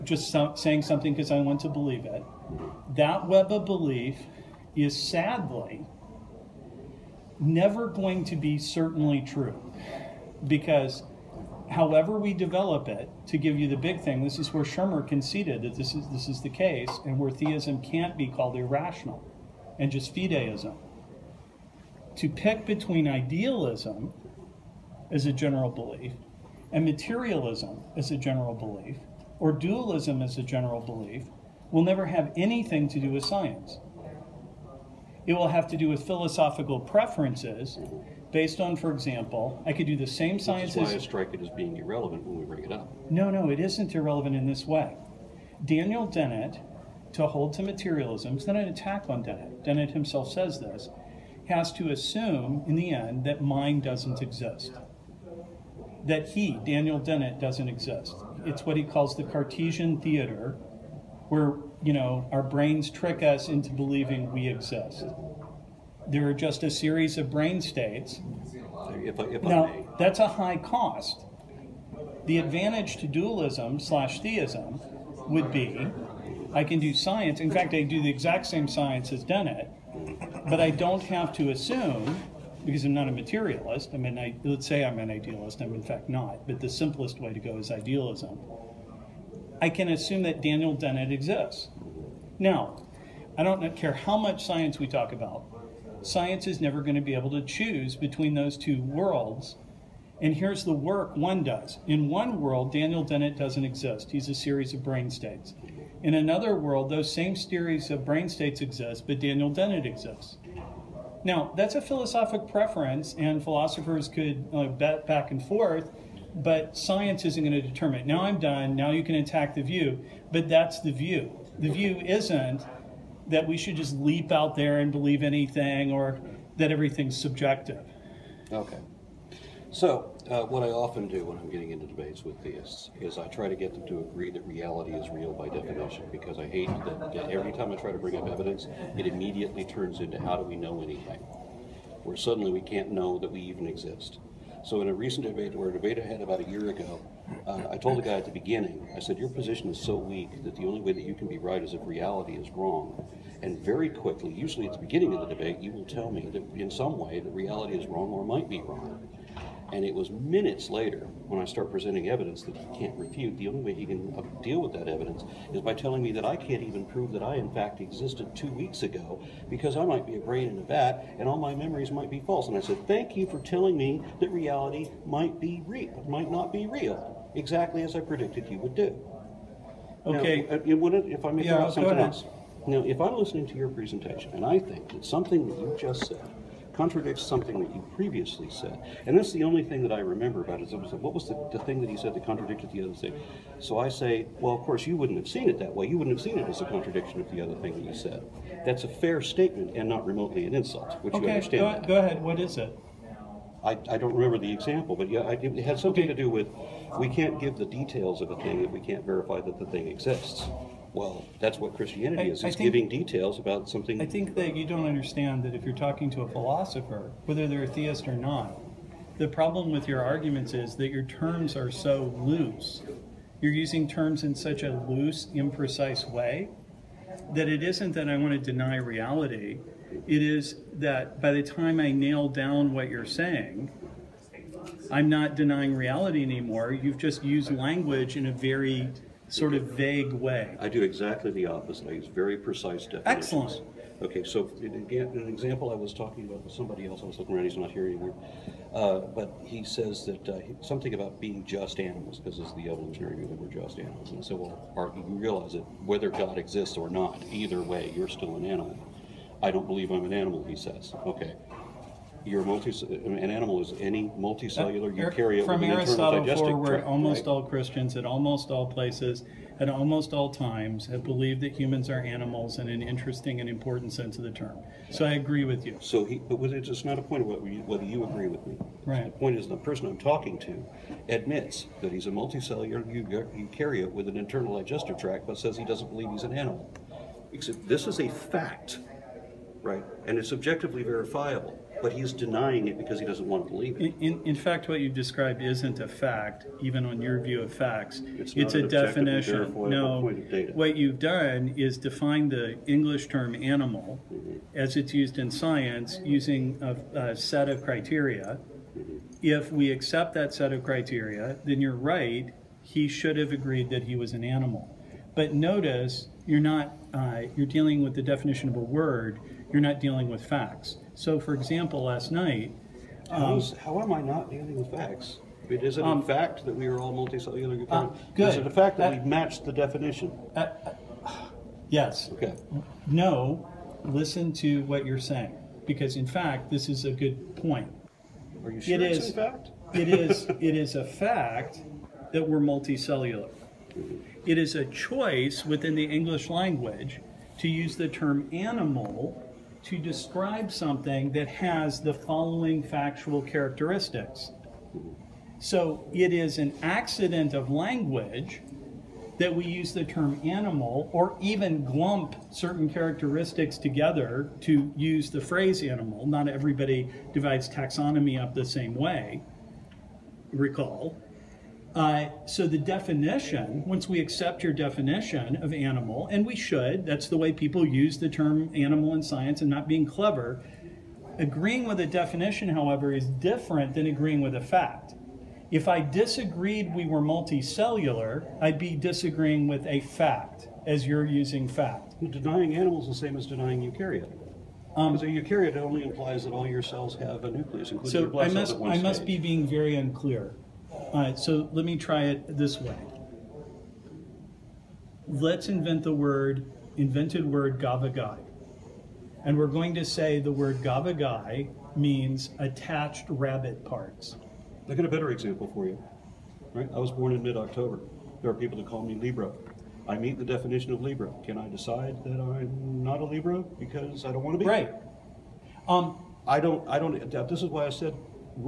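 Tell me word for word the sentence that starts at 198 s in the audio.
That's a fair statement and not remotely an insult, which okay, you understand.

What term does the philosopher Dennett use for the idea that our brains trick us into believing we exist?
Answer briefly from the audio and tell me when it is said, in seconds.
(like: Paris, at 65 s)
Cartesian theater, at 59 s.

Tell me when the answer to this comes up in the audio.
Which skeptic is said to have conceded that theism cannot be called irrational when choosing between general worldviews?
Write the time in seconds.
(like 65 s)
14 s.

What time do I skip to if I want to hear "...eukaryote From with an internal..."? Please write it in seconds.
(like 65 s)
264 s.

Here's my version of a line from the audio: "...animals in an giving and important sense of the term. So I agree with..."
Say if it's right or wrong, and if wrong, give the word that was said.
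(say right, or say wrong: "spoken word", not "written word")
wrong: "interesting", not "giving".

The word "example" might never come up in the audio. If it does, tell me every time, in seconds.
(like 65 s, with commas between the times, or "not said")
38 s, 204 s, 245 s, 321 s, 415 s.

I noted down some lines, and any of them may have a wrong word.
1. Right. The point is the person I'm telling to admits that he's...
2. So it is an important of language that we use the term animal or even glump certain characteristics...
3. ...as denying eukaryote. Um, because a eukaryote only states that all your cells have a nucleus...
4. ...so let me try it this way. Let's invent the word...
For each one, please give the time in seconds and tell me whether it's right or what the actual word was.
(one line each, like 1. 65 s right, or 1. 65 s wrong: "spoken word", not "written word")
1. 278 s wrong: "talking", not "telling"
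2. 355 s wrong: "accident", not "important"
3. 393 s wrong: "implies", not "states"
4. 401 s right.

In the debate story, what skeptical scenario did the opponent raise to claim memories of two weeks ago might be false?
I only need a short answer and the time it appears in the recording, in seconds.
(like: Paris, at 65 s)
brain in a vat, at 170 s.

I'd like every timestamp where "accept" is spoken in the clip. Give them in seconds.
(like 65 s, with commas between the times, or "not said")
309 s, 374 s.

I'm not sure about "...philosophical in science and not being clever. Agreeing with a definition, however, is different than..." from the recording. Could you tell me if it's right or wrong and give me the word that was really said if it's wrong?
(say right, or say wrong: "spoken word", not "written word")
wrong: "animal", not "philosophical".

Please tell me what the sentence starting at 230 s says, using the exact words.
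It is that by the time I nail down what you're saying, I'm not denying reality anymore.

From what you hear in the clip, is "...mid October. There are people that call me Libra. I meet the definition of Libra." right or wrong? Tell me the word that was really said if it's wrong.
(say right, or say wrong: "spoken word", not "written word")
right.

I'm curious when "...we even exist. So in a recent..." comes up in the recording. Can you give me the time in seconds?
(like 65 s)
143 s.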